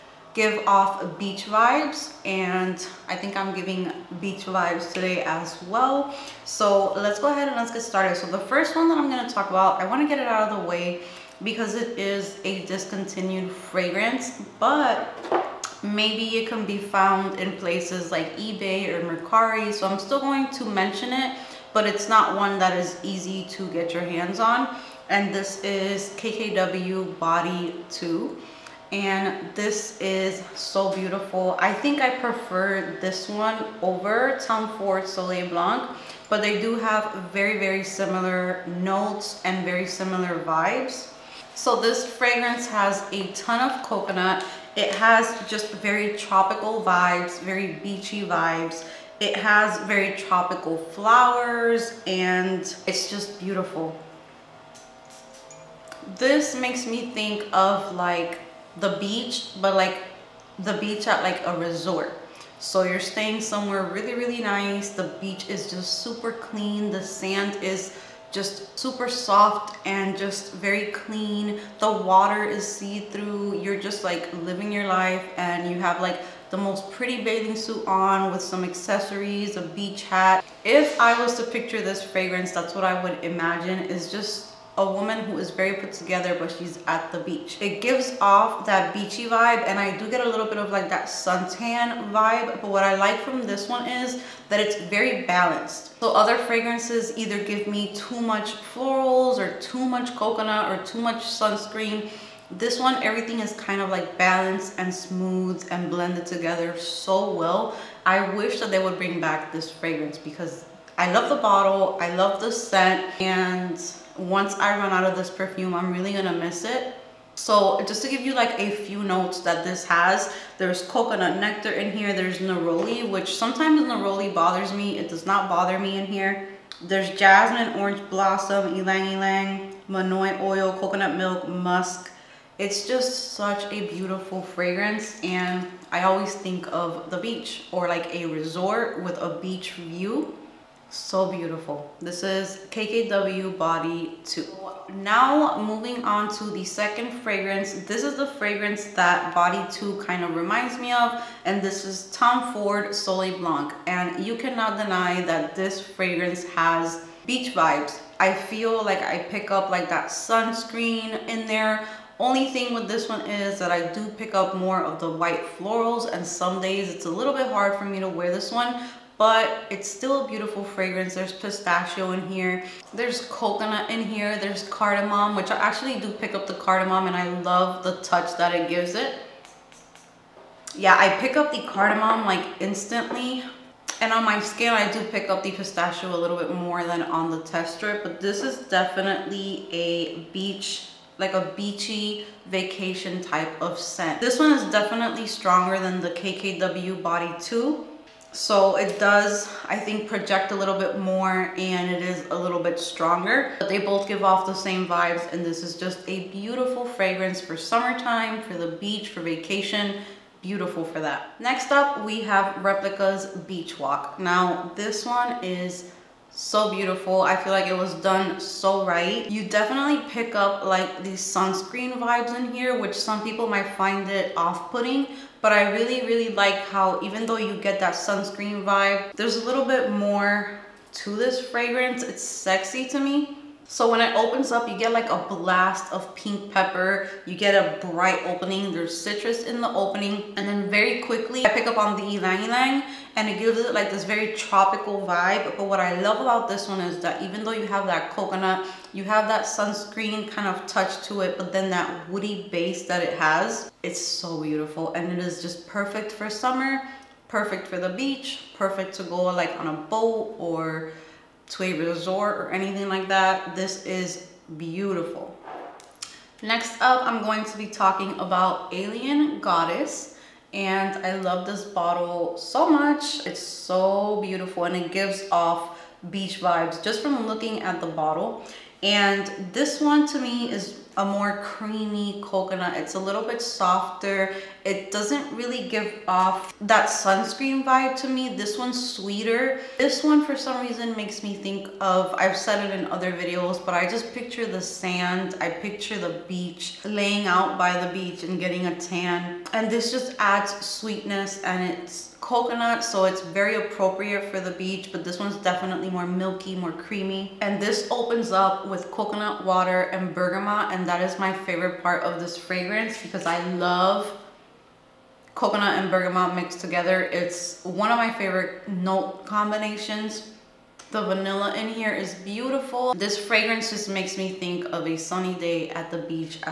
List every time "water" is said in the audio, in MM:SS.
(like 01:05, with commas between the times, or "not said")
01:11, 05:09.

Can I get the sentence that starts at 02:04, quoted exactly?
It does not bother me in here.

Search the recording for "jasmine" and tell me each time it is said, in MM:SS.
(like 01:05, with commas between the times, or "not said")
02:07.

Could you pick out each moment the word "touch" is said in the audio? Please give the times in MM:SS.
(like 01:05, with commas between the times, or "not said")
02:58, 04:10.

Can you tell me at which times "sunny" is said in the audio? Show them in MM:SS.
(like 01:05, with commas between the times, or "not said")
05:24.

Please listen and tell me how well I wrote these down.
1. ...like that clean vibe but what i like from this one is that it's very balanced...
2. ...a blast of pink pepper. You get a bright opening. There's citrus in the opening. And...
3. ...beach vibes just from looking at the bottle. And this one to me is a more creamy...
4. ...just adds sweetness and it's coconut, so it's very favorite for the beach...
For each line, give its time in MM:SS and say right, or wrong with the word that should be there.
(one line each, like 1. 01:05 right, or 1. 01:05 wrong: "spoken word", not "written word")
1. 01:30 wrong: "suntan", not "clean"
2. 03:55 right
3. 04:36 right
4. 04:59 wrong: "appropriate", not "favorite".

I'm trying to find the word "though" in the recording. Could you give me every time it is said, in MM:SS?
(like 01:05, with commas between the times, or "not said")
03:47, 04:07.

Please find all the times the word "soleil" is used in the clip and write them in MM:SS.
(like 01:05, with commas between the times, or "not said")
00:35, 02:32.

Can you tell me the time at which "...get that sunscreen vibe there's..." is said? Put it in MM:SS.
03:47.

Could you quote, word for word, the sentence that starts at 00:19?
So I'm still going to mention it, but it's not one that is easy to get your hands on.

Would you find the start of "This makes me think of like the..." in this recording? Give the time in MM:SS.
00:56.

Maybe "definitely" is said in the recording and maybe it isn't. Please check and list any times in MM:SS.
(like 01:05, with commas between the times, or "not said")
03:08, 03:14, 03:39, 05:05.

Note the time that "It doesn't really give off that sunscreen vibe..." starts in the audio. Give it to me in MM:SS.
04:44.